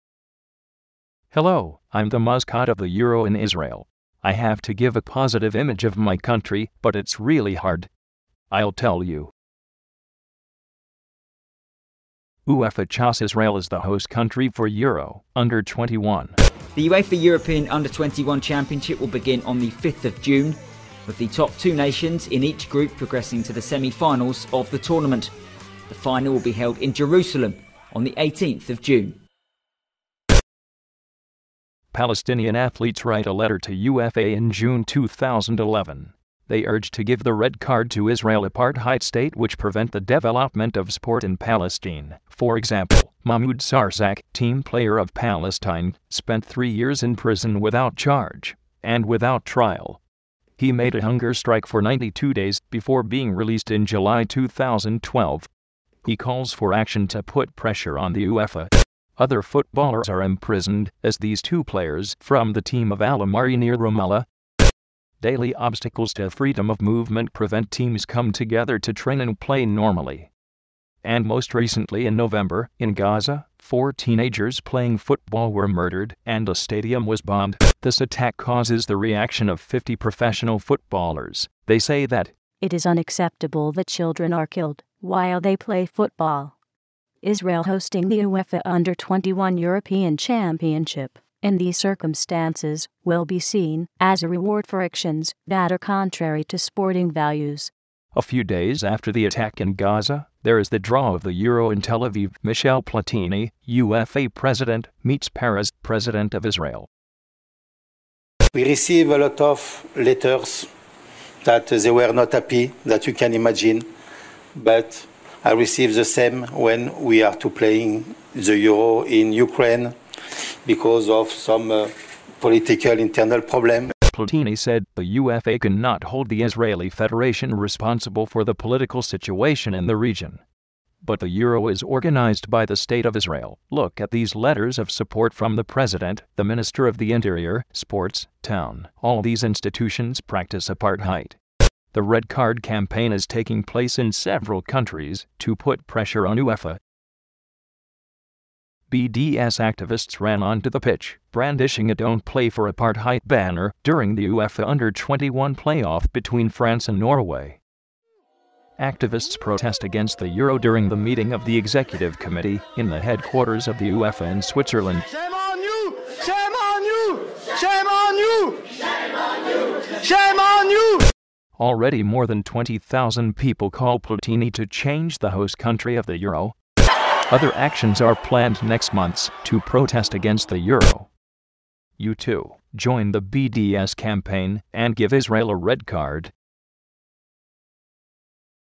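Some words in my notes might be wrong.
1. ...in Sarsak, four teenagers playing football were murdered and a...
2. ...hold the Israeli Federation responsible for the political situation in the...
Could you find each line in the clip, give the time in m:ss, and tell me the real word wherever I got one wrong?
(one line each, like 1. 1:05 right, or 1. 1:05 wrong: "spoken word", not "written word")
1. 1:12 wrong: "Gaza", not "Sarsak"
2. 2:06 right.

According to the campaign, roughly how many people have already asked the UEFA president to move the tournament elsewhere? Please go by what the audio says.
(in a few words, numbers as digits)
20,000.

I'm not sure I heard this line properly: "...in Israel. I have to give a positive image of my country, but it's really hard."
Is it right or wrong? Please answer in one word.
right.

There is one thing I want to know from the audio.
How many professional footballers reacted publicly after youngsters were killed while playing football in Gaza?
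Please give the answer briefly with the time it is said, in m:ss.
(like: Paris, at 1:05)
50, at 1:19.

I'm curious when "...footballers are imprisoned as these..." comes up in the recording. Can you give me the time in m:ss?
0:59.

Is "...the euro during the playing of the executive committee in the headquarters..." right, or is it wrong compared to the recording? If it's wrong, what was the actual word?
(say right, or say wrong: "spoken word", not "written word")
wrong: "meeting", not "playing".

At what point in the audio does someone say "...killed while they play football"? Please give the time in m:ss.
1:24.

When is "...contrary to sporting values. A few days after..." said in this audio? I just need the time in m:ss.
1:35.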